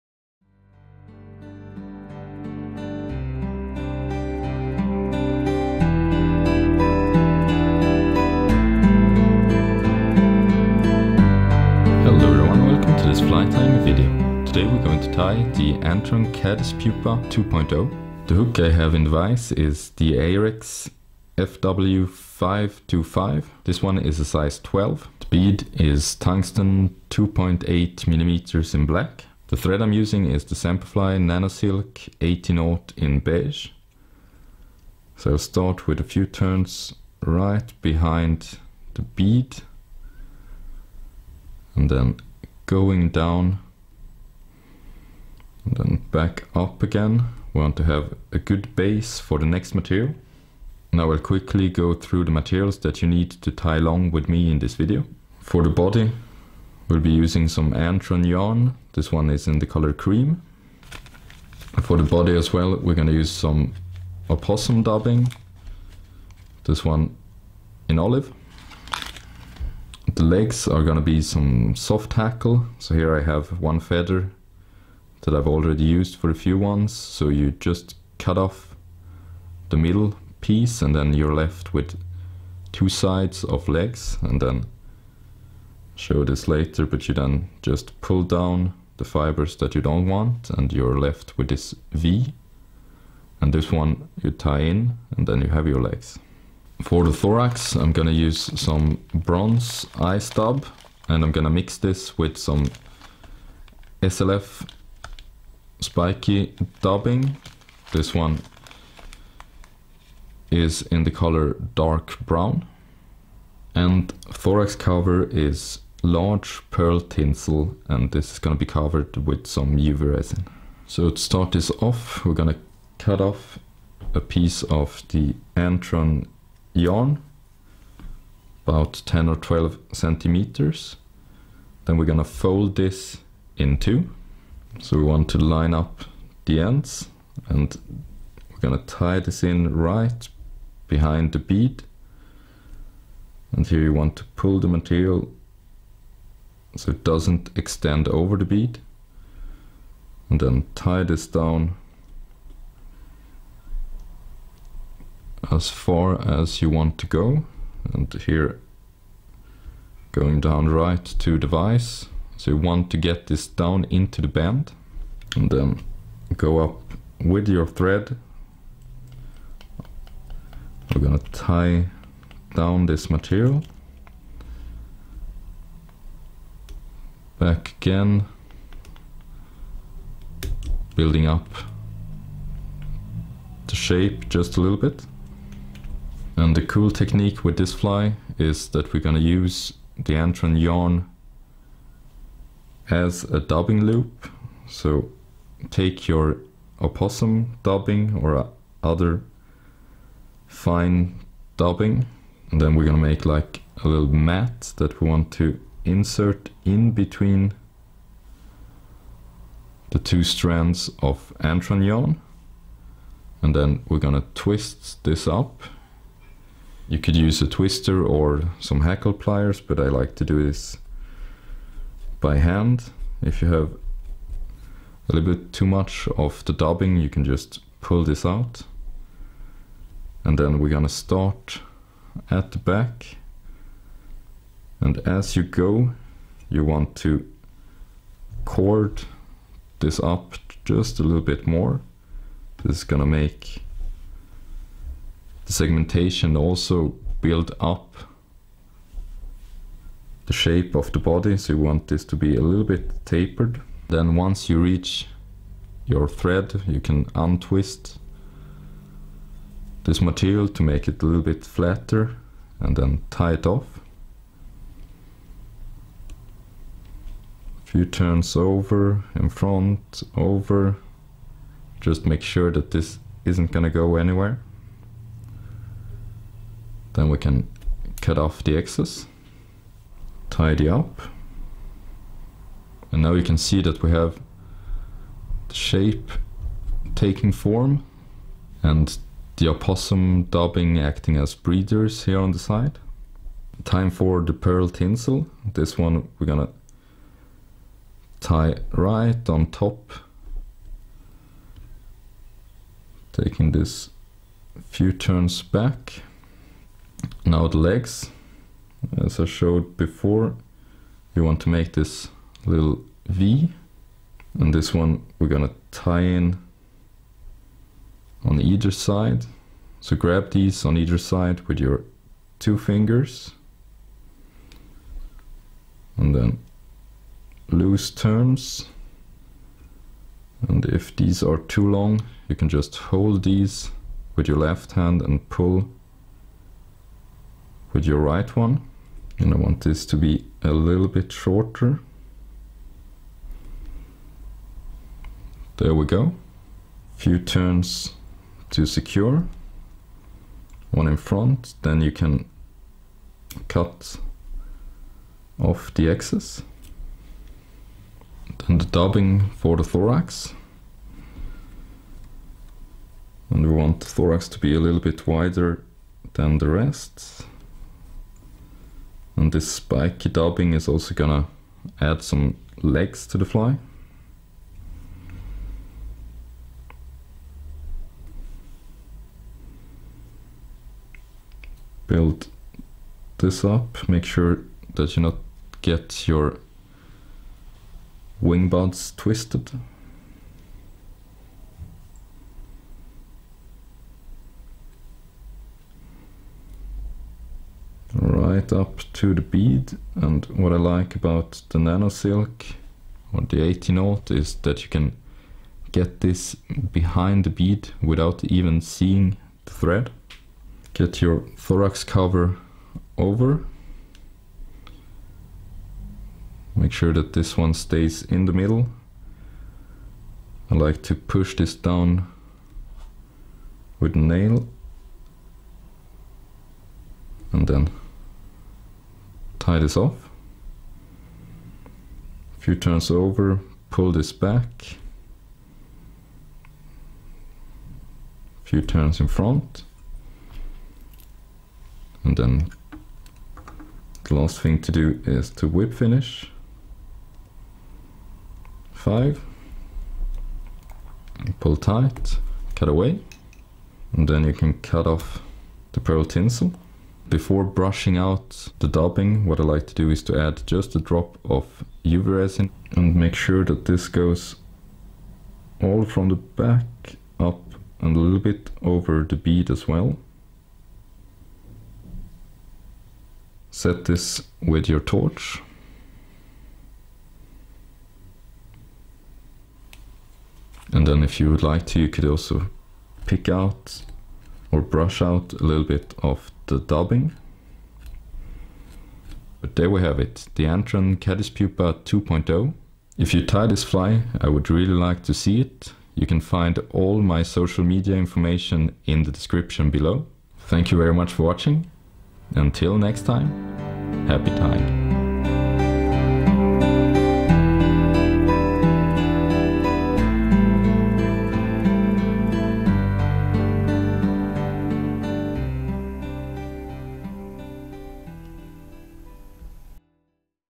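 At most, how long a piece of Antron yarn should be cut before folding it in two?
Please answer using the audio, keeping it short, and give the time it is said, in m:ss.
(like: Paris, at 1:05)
12 centimeters, at 2:09.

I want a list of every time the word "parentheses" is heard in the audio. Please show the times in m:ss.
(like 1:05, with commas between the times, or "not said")
not said.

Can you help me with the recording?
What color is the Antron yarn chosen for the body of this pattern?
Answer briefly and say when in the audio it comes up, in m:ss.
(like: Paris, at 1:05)
cream, at 0:59.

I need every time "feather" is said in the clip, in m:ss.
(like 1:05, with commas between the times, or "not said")
1:13.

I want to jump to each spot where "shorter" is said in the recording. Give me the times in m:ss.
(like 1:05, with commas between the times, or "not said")
5:41.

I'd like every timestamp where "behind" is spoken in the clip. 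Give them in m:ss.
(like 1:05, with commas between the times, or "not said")
0:37, 2:20, 6:46.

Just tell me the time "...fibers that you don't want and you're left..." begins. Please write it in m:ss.
1:29.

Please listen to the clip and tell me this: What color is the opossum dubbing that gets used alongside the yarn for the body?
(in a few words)
olive.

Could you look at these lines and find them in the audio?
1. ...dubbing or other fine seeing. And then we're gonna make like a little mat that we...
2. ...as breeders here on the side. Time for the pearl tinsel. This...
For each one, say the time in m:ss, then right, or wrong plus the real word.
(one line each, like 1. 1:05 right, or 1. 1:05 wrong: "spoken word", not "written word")
1. 3:17 wrong: "dubbing", not "seeing"
2. 4:51 right.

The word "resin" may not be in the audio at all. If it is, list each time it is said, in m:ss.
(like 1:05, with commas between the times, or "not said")
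2:00, 7:42.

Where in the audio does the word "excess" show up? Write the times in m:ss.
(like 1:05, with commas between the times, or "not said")
4:38, 5:55.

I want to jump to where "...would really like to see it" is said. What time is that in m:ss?
8:14.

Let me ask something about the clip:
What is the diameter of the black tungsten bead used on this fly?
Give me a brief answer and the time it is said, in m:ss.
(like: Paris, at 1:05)
2.8 millimeters, at 0:27.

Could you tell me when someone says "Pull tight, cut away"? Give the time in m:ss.
7:31.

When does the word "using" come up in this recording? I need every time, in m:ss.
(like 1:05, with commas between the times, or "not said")
0:29, 0:57.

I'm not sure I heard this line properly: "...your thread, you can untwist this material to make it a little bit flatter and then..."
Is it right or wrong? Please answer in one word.
right.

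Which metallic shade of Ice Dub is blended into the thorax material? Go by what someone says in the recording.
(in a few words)
bronze.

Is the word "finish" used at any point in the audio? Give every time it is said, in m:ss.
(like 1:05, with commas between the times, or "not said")
7:25.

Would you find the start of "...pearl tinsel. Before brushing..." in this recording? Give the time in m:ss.
7:35.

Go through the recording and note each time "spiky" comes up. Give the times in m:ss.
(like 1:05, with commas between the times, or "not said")
1:45, 6:09.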